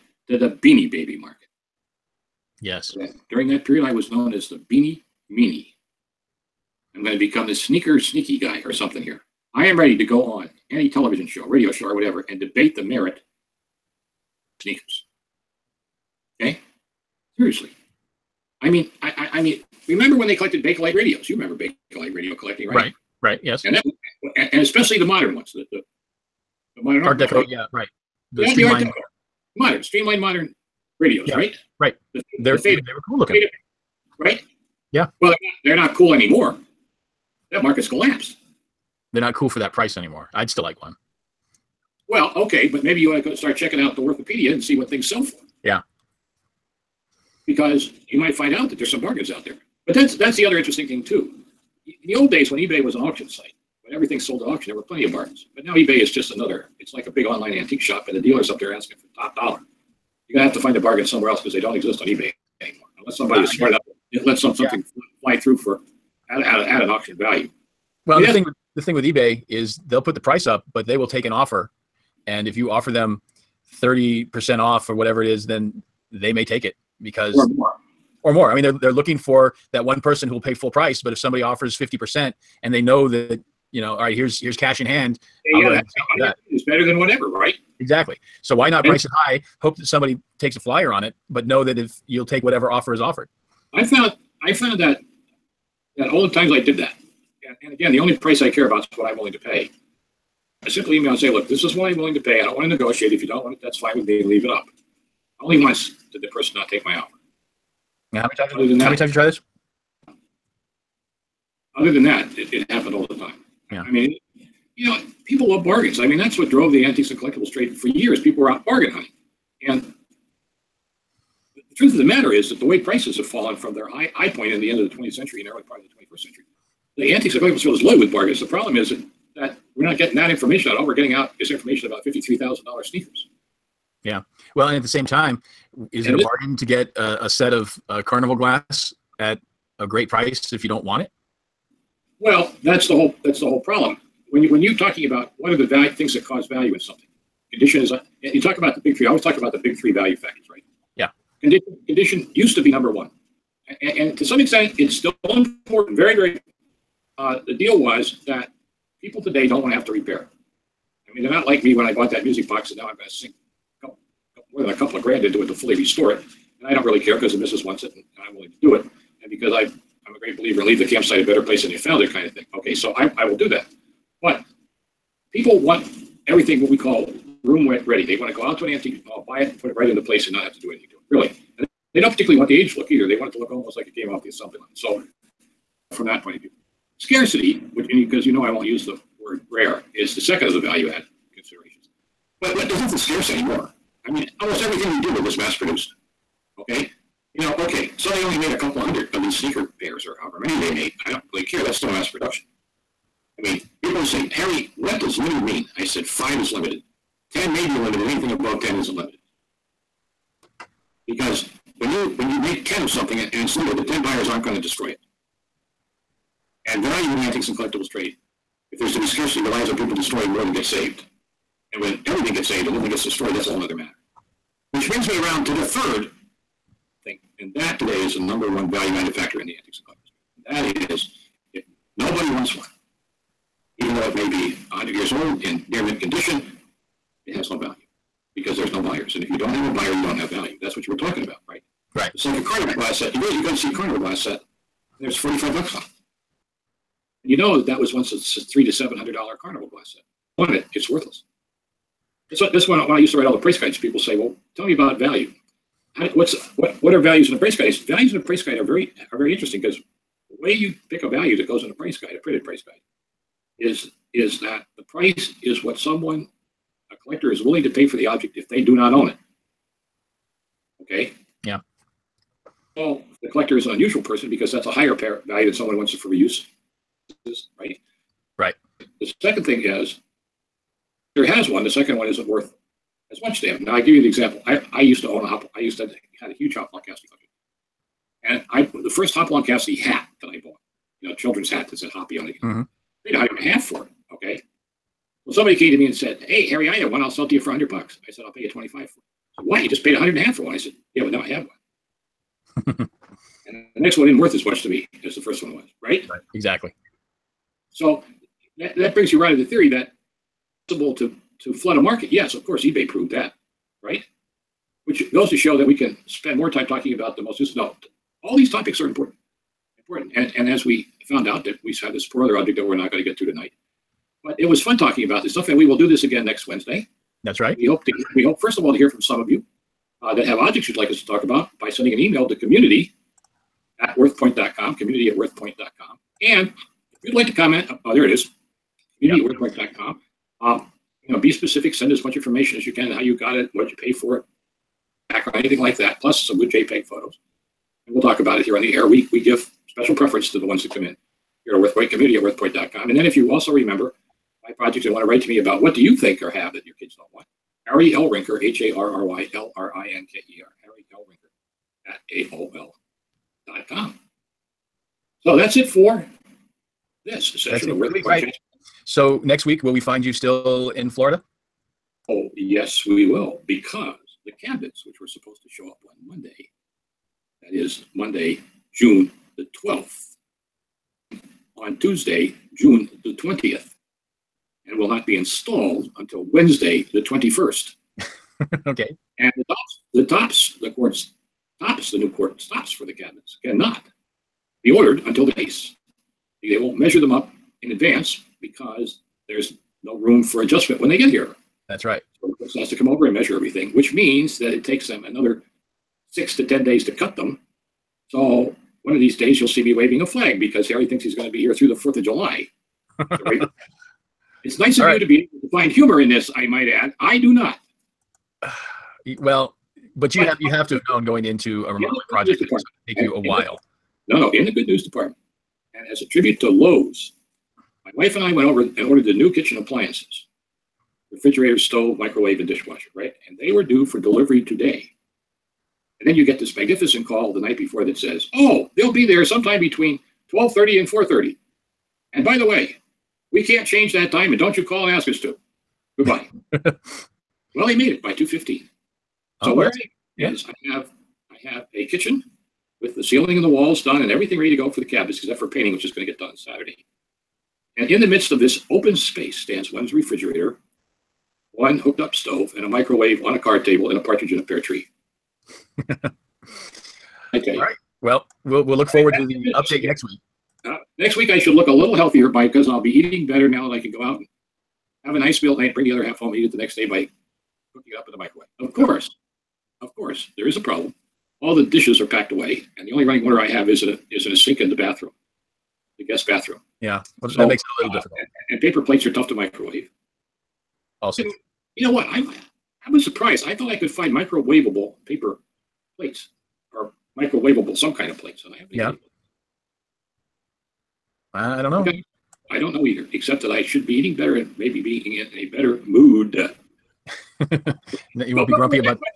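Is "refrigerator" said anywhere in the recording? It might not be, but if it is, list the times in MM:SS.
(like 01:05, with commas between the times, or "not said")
07:11, 07:39.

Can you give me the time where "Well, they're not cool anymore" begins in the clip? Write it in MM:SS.
00:35.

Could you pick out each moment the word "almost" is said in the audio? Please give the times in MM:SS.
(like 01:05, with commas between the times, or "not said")
03:03, 03:14.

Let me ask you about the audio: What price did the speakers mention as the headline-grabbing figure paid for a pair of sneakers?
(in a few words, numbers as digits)
$53,000.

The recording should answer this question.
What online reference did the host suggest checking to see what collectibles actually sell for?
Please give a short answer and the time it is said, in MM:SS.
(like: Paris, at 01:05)
The Worthopedia, at 00:43.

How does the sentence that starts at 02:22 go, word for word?
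Well, that's the whole that's the whole problem.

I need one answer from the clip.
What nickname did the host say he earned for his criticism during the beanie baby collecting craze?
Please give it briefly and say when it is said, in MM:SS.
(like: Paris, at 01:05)
The beanie meanie, at 00:04.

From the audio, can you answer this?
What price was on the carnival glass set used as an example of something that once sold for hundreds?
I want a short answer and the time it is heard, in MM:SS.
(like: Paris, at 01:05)
$45, at 04:05.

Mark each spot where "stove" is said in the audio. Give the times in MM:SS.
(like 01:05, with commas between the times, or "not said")
07:11, 07:42.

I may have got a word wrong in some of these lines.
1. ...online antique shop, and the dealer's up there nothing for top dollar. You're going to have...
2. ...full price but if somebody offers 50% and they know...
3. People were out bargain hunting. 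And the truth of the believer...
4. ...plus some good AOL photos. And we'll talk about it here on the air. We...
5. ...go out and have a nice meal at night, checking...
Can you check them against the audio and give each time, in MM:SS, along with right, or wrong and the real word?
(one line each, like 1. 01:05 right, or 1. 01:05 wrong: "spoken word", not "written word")
1. 00:57 wrong: "asking", not "nothing"
2. 01:20 right
3. 01:58 wrong: "matter", not "believer"
4. 05:45 wrong: "JPEG", not "AOL"
5. 07:53 wrong: "bring", not "checking".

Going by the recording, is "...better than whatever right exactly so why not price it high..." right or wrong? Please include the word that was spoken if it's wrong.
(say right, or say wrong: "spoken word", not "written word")
right.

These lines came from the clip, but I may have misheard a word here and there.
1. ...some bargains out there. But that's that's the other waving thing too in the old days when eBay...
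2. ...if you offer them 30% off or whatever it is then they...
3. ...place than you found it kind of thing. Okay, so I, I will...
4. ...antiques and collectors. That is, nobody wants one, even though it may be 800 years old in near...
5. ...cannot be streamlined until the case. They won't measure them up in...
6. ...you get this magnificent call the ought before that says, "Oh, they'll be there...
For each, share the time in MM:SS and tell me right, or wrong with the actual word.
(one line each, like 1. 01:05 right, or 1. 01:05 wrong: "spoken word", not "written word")
1. 00:48 wrong: "interesting", not "waving"
2. 01:12 right
3. 02:51 right
4. 03:49 wrong: "100", not "800"
5. 06:33 wrong: "ordered", not "streamlined"
6. 07:16 wrong: "night", not "ought".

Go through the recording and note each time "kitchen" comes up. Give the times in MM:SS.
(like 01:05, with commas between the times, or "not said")
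07:09, 07:31.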